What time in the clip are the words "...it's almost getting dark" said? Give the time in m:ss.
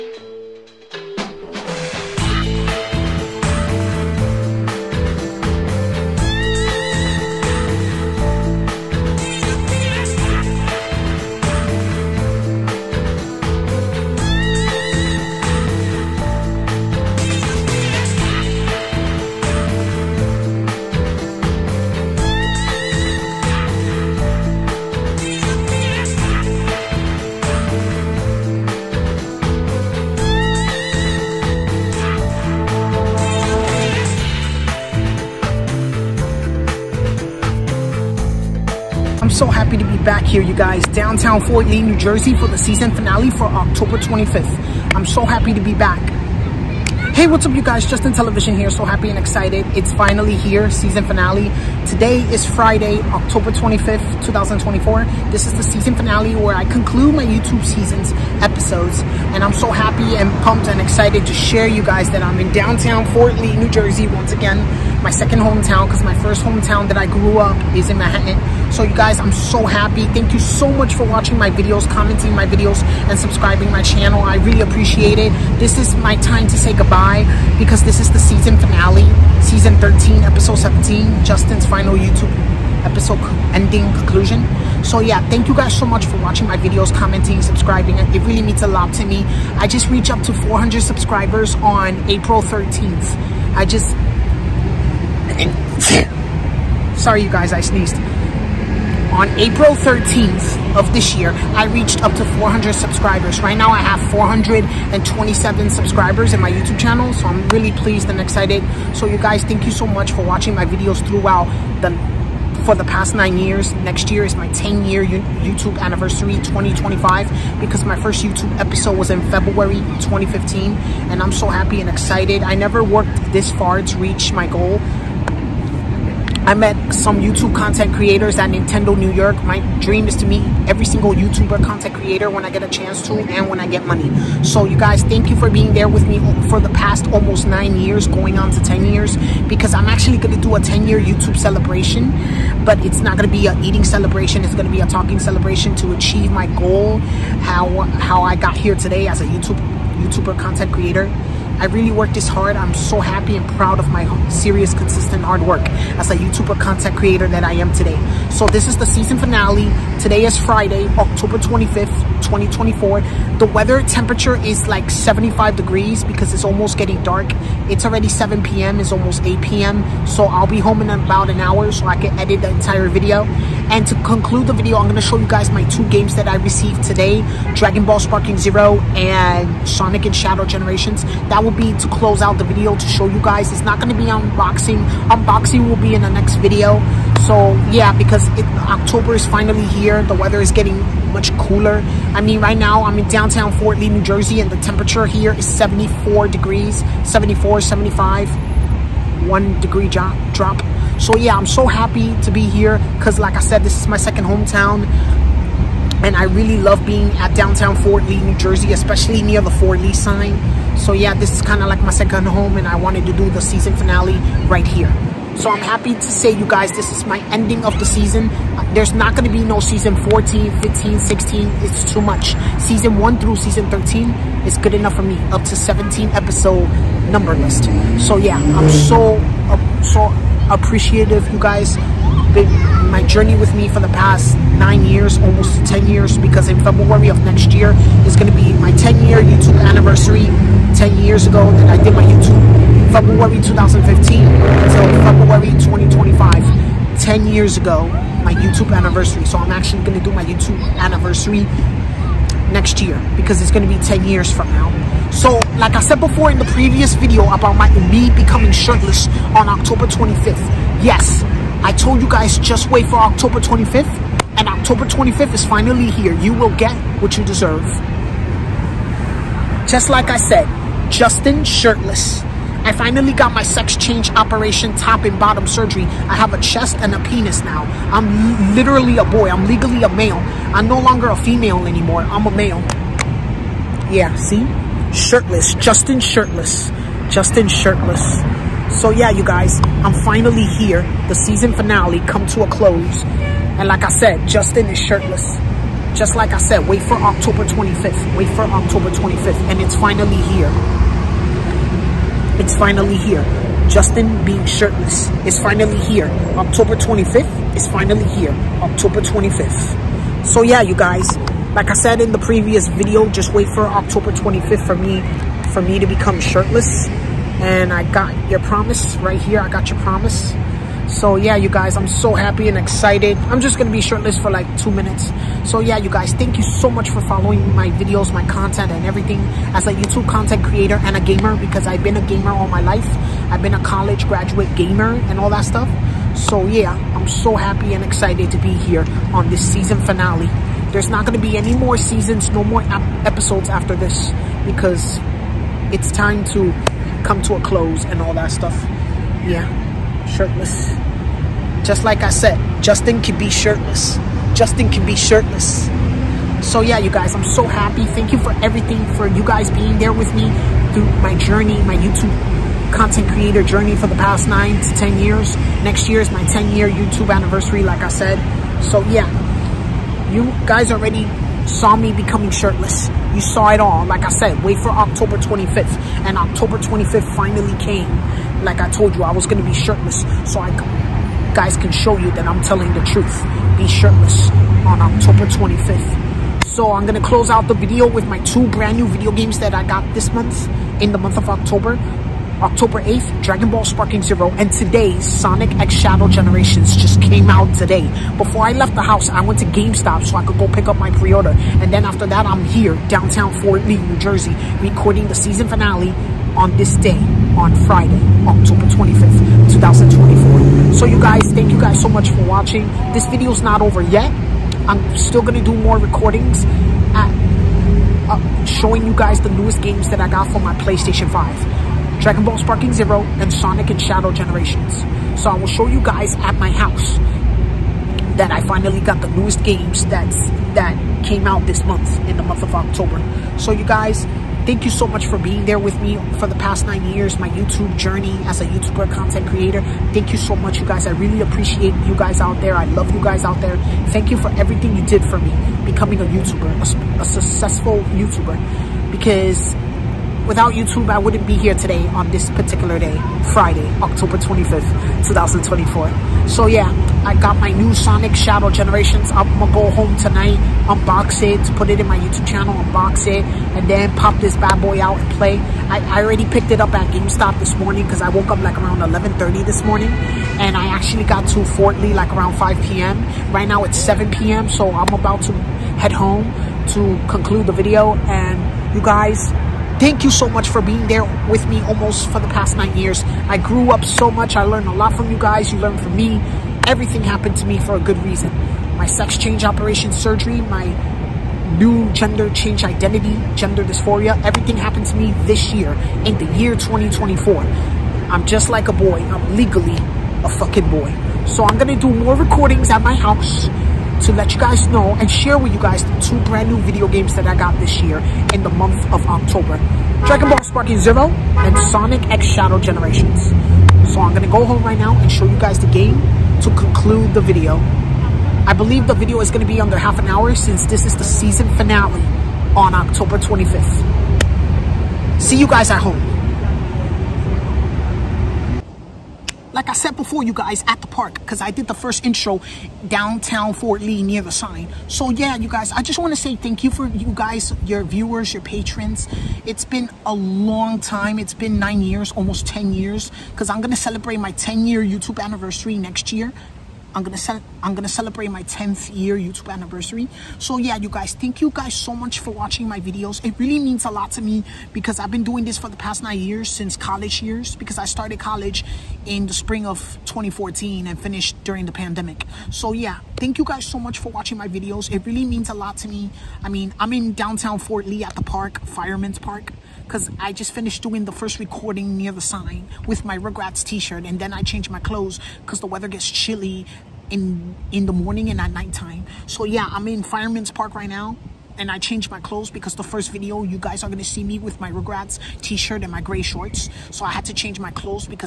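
2:46.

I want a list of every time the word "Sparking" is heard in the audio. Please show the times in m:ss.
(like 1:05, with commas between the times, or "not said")
2:57, 6:33, 7:02, 8:30.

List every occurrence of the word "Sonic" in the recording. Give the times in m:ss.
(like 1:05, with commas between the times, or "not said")
2:59, 6:34, 7:03, 7:37, 8:31.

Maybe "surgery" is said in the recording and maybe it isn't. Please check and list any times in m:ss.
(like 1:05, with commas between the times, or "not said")
4:35, 8:09.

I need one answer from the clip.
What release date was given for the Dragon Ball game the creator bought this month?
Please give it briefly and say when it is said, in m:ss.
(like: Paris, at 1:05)
October 8th, at 6:32.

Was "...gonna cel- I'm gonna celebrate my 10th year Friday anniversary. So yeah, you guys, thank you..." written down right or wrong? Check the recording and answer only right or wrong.
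wrong.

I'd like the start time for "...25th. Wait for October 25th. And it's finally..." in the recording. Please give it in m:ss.
4:57.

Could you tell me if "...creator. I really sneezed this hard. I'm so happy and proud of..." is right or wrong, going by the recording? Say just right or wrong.
wrong.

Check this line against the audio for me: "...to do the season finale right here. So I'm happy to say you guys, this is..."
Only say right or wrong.
right.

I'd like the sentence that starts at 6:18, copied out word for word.
Like I told you, I was going to be shirtless.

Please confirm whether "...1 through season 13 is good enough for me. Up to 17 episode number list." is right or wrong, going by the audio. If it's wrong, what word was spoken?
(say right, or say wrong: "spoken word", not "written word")
right.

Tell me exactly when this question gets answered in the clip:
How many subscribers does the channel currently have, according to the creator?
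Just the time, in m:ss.
1:44.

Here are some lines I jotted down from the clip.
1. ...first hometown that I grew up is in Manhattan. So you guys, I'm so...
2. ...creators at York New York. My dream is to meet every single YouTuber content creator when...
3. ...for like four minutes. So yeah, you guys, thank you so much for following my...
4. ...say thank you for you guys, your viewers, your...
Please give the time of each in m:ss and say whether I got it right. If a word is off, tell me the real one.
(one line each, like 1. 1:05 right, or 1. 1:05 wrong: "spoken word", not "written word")
1. 1:06 right
2. 2:07 wrong: "Nintendo", not "York"
3. 5:24 wrong: "two", not "four"
4. 8:56 right.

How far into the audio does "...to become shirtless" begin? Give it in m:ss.
5:15.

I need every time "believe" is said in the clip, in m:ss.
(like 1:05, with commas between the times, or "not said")
8:38.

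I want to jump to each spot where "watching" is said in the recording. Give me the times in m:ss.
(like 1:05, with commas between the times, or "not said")
1:11, 1:26, 1:50, 6:52, 9:12, 9:24.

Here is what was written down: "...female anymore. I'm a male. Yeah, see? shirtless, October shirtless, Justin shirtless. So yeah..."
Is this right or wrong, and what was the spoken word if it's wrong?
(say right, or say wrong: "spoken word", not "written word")
wrong: "Justin", not "October".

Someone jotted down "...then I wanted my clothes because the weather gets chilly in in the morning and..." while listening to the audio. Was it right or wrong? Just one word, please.
wrong.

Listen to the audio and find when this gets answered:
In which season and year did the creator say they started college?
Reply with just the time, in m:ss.
9:19.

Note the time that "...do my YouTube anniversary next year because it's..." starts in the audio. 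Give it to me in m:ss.
4:10.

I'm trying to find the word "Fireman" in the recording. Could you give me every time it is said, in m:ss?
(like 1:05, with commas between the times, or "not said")
9:28, 9:40.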